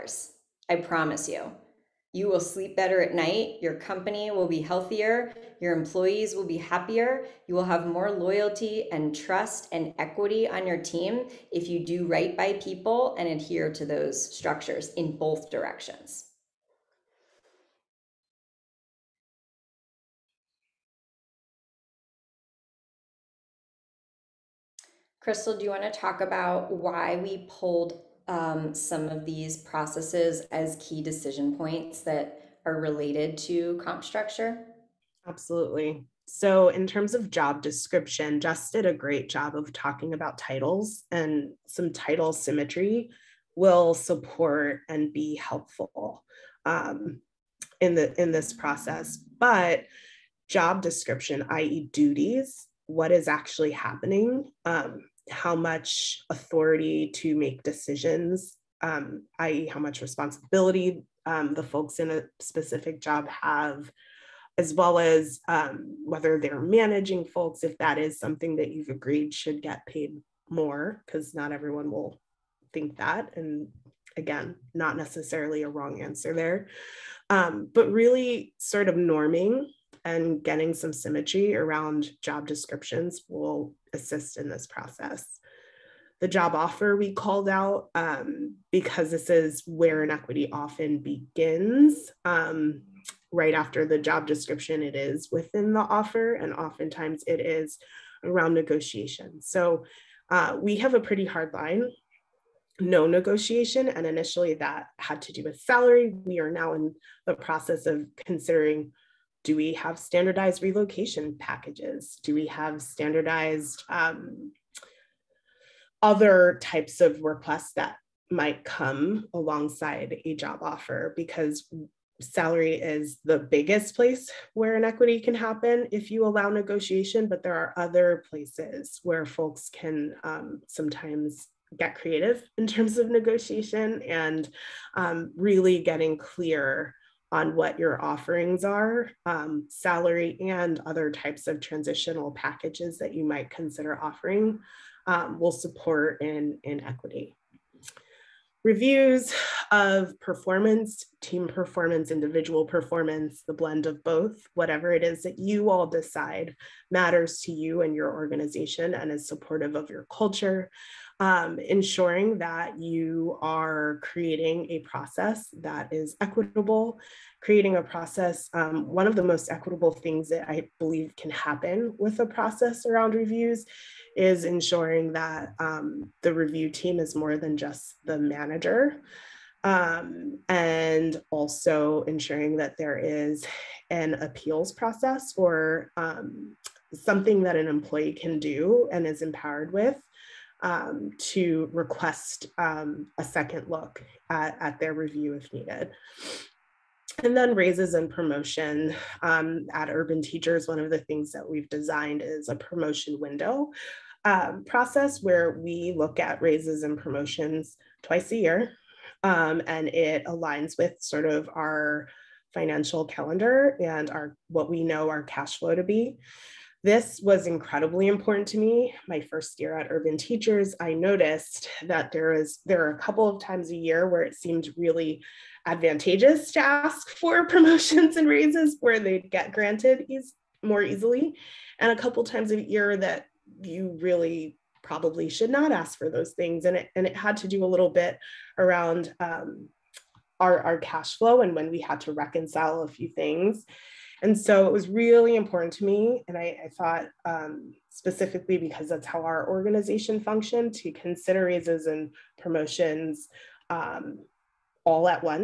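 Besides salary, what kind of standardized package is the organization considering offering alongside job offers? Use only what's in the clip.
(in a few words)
Relocation packages.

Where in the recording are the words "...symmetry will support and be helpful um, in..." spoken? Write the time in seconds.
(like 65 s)
42 s.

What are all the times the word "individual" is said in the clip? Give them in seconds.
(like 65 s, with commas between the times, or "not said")
152 s.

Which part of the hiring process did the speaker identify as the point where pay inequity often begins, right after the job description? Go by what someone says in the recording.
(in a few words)
The job offer.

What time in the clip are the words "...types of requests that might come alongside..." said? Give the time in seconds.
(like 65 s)
116 s.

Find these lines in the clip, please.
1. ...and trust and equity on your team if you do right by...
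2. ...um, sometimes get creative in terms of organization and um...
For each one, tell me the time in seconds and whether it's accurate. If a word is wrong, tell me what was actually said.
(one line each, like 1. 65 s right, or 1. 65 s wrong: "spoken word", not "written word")
1. 8 s right
2. 130 s wrong: "negotiation", not "organization".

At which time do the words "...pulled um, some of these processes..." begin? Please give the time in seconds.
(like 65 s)
27 s.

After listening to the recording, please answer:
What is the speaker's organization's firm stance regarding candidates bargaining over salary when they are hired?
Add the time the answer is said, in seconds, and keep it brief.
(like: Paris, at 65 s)
No negotiation, at 102 s.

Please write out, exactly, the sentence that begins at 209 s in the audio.
Um, and it aligns with sort of our financial calendar and our what we know our cash flow to be.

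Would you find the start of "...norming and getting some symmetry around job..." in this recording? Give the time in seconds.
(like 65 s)
78 s.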